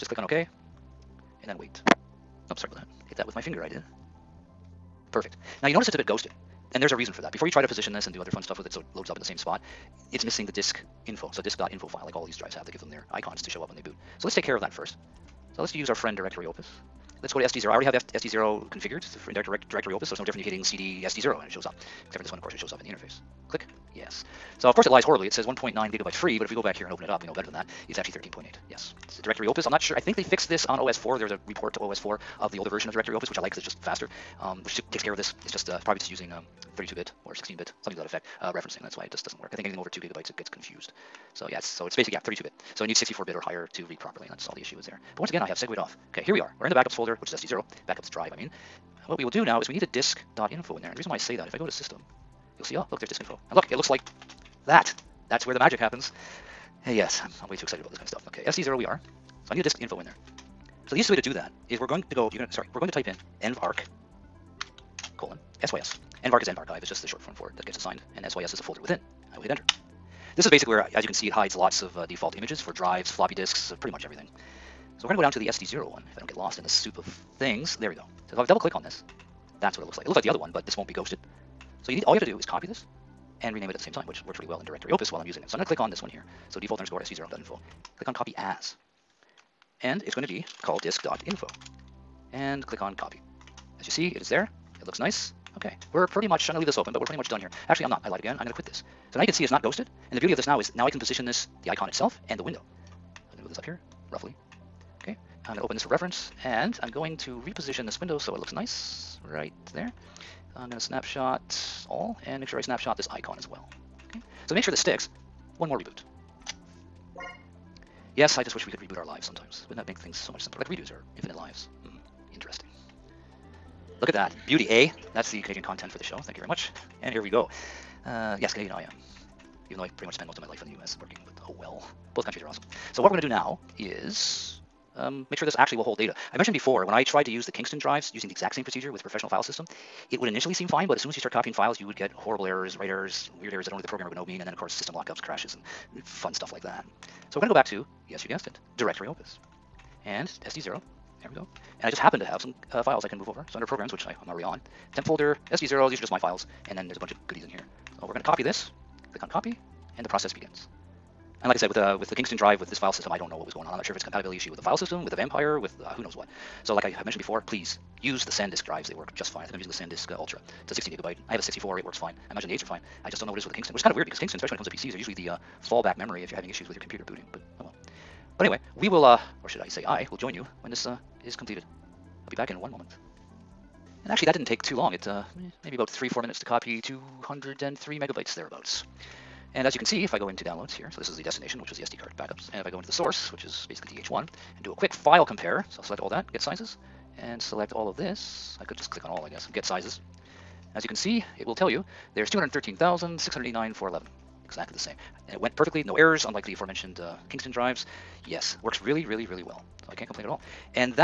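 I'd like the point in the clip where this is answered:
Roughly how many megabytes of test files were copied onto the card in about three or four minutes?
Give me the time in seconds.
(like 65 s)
186 s.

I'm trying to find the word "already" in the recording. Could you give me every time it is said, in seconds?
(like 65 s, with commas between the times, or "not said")
17 s, 154 s.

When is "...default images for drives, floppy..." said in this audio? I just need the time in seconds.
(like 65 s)
72 s.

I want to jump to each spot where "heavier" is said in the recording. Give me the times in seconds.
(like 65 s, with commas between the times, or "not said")
not said.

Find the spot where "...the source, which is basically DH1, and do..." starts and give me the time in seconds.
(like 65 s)
192 s.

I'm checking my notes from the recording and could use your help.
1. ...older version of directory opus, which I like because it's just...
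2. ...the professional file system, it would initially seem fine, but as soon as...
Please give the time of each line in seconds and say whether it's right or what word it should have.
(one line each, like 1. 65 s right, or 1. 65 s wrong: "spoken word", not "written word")
1. 32 s right
2. 138 s right.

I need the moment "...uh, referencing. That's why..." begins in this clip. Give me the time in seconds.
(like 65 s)
38 s.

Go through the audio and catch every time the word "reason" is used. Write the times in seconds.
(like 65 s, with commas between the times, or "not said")
6 s, 50 s.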